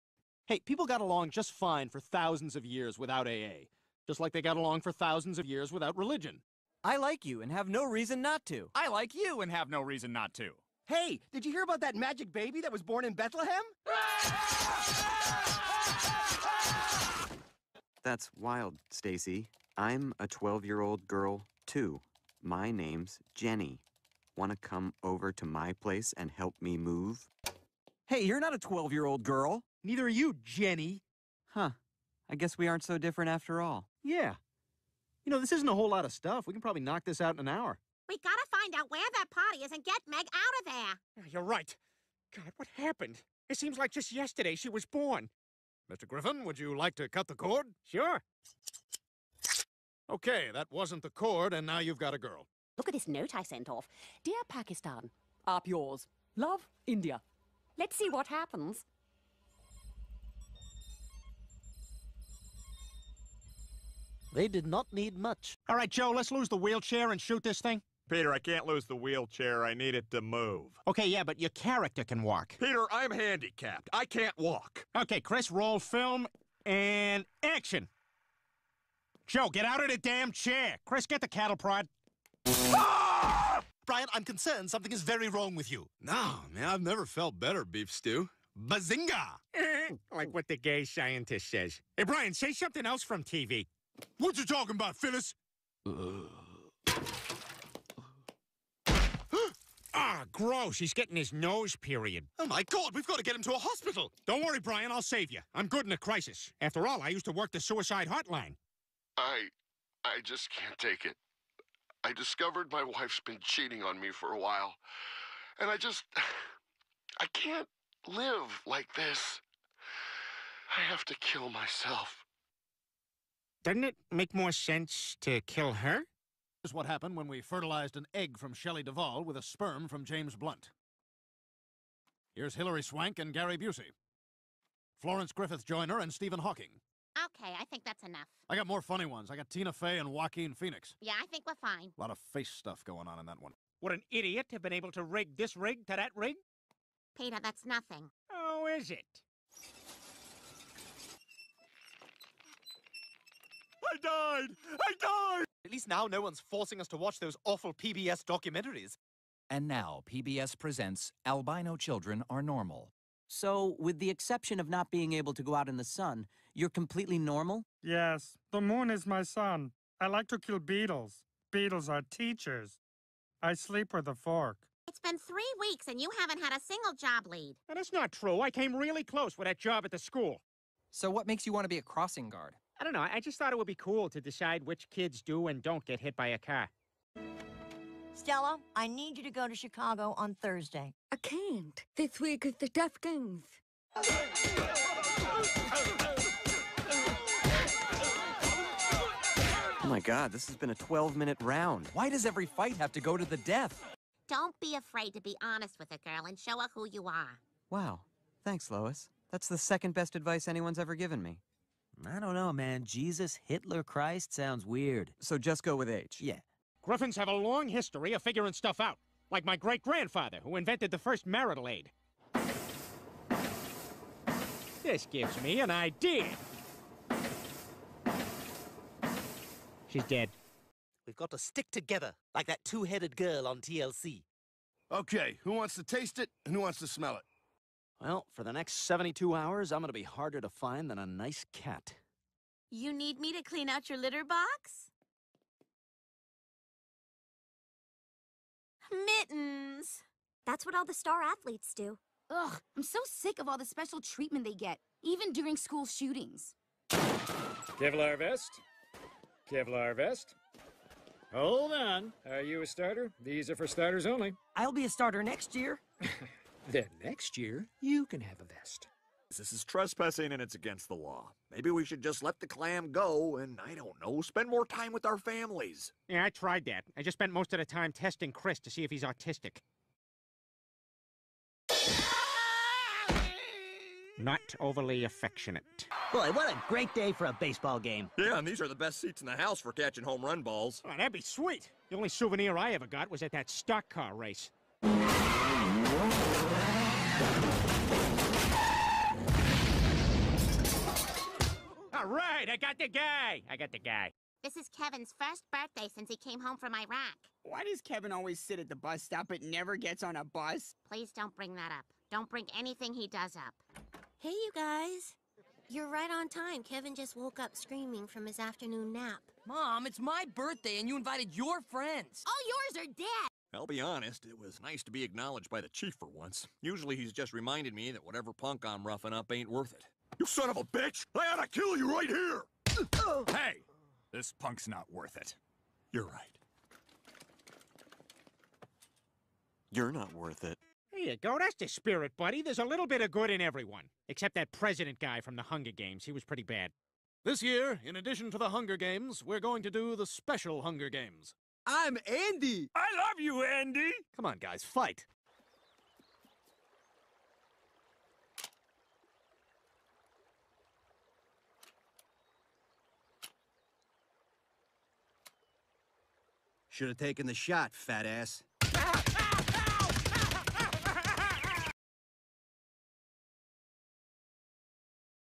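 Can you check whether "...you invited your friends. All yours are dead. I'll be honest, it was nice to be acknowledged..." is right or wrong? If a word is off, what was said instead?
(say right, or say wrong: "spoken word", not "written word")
right.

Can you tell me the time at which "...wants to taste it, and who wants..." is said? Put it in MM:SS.
03:55.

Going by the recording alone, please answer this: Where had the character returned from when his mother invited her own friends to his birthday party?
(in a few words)
Iraq.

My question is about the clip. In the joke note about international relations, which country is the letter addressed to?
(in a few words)
Pakistan.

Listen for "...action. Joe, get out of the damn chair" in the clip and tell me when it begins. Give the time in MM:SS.
01:17.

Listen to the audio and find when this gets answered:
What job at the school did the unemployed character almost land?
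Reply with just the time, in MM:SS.
03:01.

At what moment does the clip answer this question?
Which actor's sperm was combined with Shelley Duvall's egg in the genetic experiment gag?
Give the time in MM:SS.
02:10.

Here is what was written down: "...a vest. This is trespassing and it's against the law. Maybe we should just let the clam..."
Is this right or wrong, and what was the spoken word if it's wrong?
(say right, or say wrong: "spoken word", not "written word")
right.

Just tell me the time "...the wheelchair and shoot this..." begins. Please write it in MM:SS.
01:06.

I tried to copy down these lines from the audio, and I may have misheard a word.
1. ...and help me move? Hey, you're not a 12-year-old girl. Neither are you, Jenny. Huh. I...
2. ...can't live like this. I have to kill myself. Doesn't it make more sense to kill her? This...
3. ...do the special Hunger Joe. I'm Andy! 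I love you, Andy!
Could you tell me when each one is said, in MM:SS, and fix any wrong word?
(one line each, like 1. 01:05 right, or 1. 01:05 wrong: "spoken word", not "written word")
1. 00:26 right
2. 01:57 right
3. 05:49 wrong: "Games", not "Joe".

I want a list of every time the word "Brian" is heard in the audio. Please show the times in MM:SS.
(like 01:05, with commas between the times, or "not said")
01:23, 01:32, 01:44.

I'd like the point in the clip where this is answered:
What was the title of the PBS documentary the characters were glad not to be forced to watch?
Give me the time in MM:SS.
02:41.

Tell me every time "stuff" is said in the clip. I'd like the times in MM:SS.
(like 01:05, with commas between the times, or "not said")
00:36, 02:22, 03:38.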